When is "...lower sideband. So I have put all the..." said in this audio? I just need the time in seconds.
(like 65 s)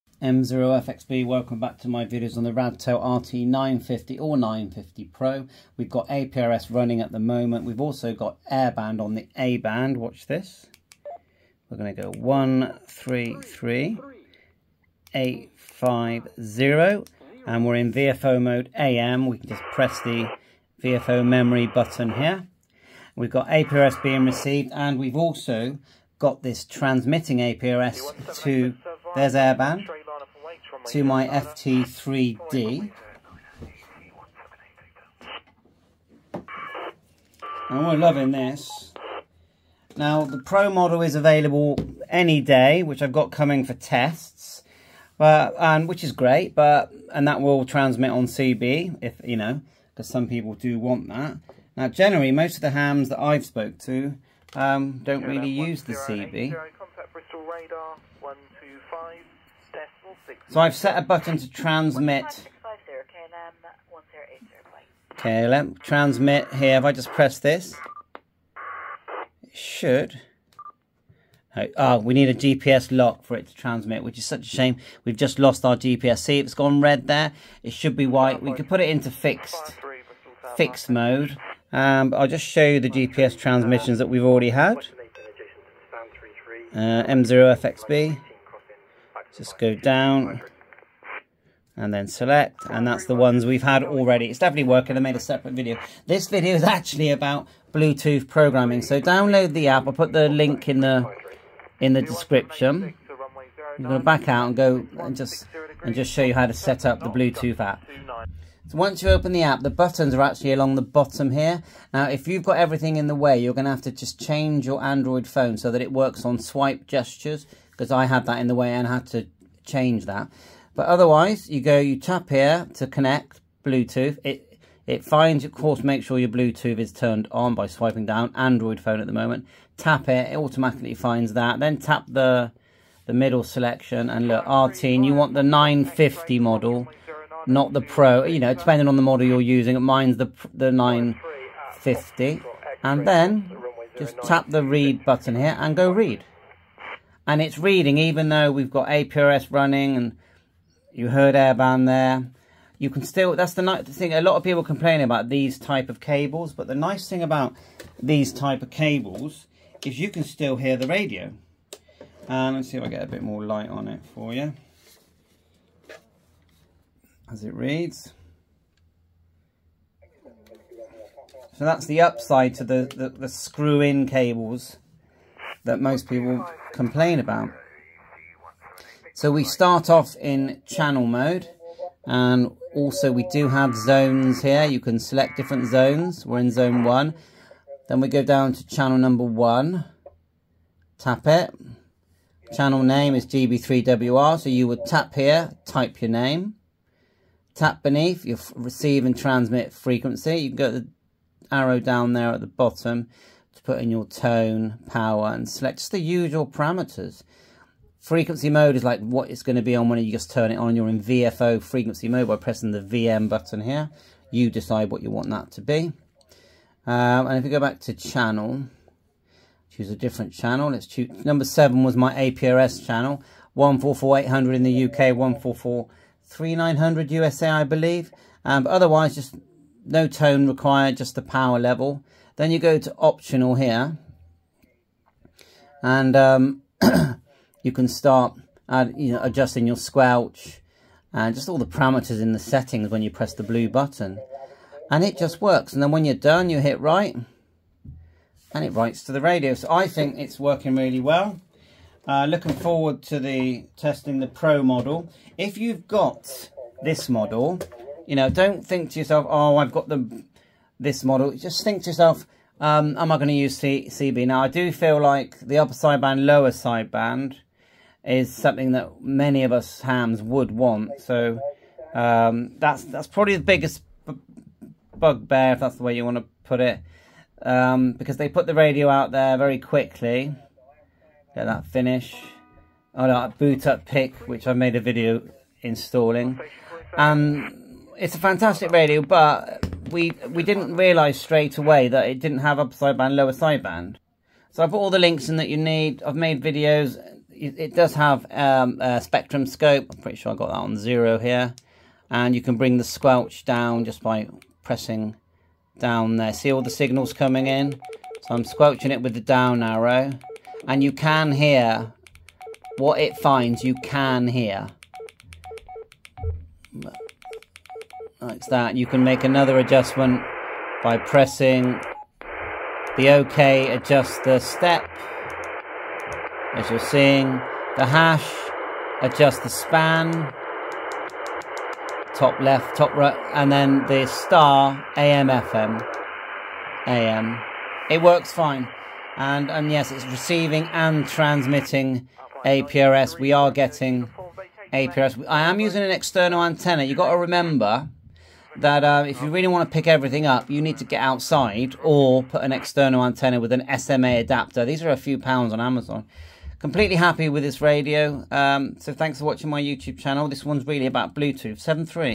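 293 s.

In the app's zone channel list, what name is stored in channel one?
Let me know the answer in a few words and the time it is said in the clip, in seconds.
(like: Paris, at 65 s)
GB3WR, at 193 s.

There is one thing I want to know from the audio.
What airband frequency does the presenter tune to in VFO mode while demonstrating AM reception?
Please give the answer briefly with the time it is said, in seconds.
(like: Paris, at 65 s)
133.850, at 12 s.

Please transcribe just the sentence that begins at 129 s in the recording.
Tap it, it automatically finds that.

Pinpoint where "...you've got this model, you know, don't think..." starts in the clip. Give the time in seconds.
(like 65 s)
255 s.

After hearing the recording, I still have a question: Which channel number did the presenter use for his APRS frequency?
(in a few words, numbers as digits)
7.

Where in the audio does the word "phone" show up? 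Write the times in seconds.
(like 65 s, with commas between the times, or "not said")
115 s, 128 s.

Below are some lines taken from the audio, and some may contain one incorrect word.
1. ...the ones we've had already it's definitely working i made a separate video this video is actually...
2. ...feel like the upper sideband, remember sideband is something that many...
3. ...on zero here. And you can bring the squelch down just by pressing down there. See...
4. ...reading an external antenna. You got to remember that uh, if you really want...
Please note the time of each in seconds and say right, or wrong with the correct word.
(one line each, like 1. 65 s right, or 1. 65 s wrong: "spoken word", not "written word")
1. 93 s right
2. 264 s wrong: "lower", not "remember"
3. 300 s right
4. 345 s wrong: "using", not "reading".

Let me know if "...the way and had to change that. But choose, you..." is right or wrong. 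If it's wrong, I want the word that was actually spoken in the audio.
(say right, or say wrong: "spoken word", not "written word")
wrong: "otherwise", not "choose".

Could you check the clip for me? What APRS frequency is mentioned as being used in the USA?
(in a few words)
144300.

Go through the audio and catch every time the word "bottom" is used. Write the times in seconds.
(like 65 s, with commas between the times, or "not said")
110 s, 202 s.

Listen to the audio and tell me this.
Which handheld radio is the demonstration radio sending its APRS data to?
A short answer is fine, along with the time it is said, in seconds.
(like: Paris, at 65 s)
FT3D, at 31 s.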